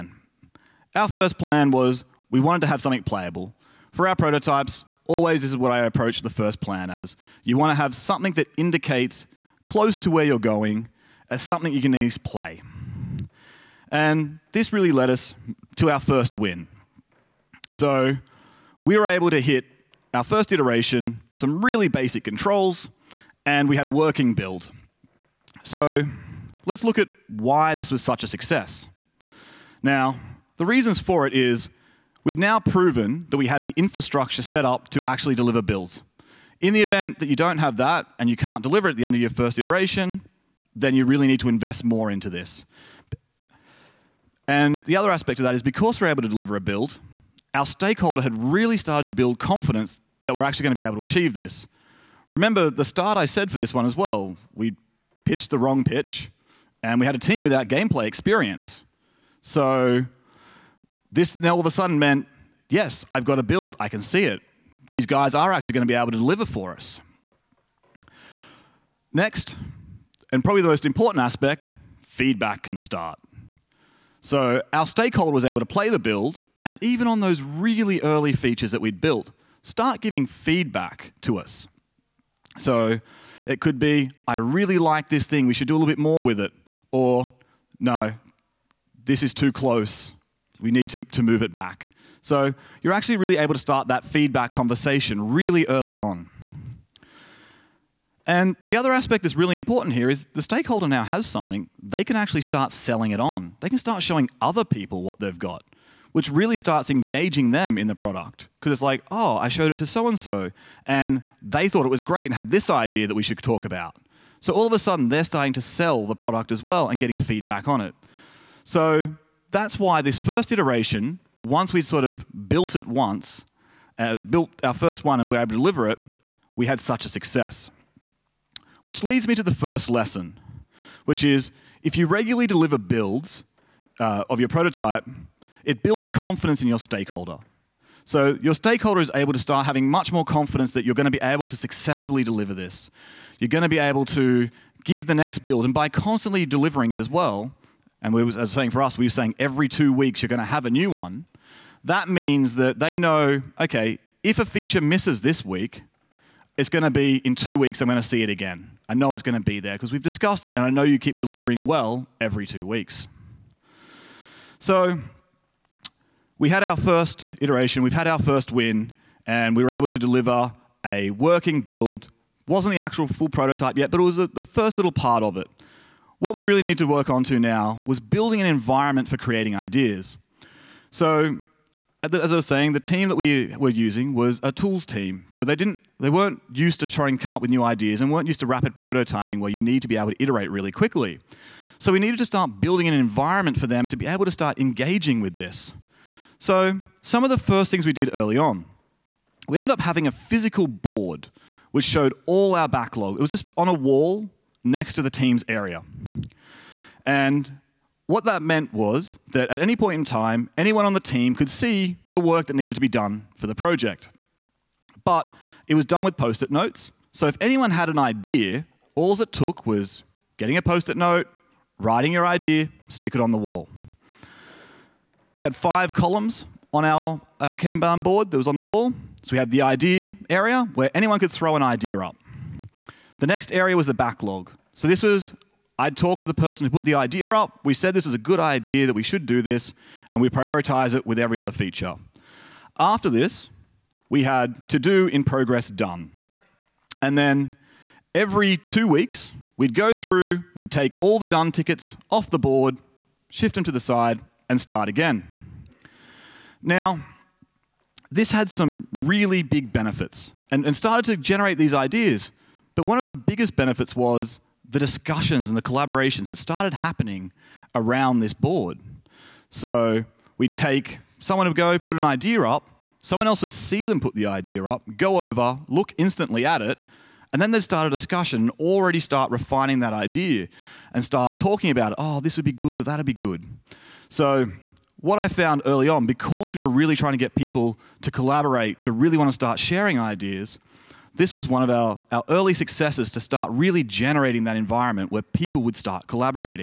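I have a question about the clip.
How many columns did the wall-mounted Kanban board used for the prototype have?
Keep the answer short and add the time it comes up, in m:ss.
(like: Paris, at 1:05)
5, at 3:45.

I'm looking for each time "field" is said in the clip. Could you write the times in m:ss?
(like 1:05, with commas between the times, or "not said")
not said.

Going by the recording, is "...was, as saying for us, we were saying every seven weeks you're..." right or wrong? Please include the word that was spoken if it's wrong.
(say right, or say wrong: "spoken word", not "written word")
wrong: "two", not "seven".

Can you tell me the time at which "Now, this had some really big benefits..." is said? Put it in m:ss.
4:16.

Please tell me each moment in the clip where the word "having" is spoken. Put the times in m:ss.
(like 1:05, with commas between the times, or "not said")
2:19, 3:19.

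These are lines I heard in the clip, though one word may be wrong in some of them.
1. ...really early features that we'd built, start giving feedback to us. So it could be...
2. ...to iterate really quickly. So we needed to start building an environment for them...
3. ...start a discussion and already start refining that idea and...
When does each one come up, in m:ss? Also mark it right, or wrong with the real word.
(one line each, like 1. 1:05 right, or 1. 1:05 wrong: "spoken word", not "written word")
1. 1:17 right
2. 3:10 right
3. 4:37 right.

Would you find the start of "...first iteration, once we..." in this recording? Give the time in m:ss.
2:00.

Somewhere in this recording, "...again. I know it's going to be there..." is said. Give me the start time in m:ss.
2:38.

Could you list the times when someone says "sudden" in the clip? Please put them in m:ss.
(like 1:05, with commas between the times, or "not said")
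1:01, 1:54.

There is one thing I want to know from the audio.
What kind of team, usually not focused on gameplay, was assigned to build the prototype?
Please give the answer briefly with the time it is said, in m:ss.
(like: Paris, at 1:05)
A tools team, at 3:04.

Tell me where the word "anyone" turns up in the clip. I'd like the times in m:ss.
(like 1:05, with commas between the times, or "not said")
3:30, 3:37, 3:50.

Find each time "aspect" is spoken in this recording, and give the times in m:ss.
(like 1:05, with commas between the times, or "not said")
0:45, 1:11, 1:38.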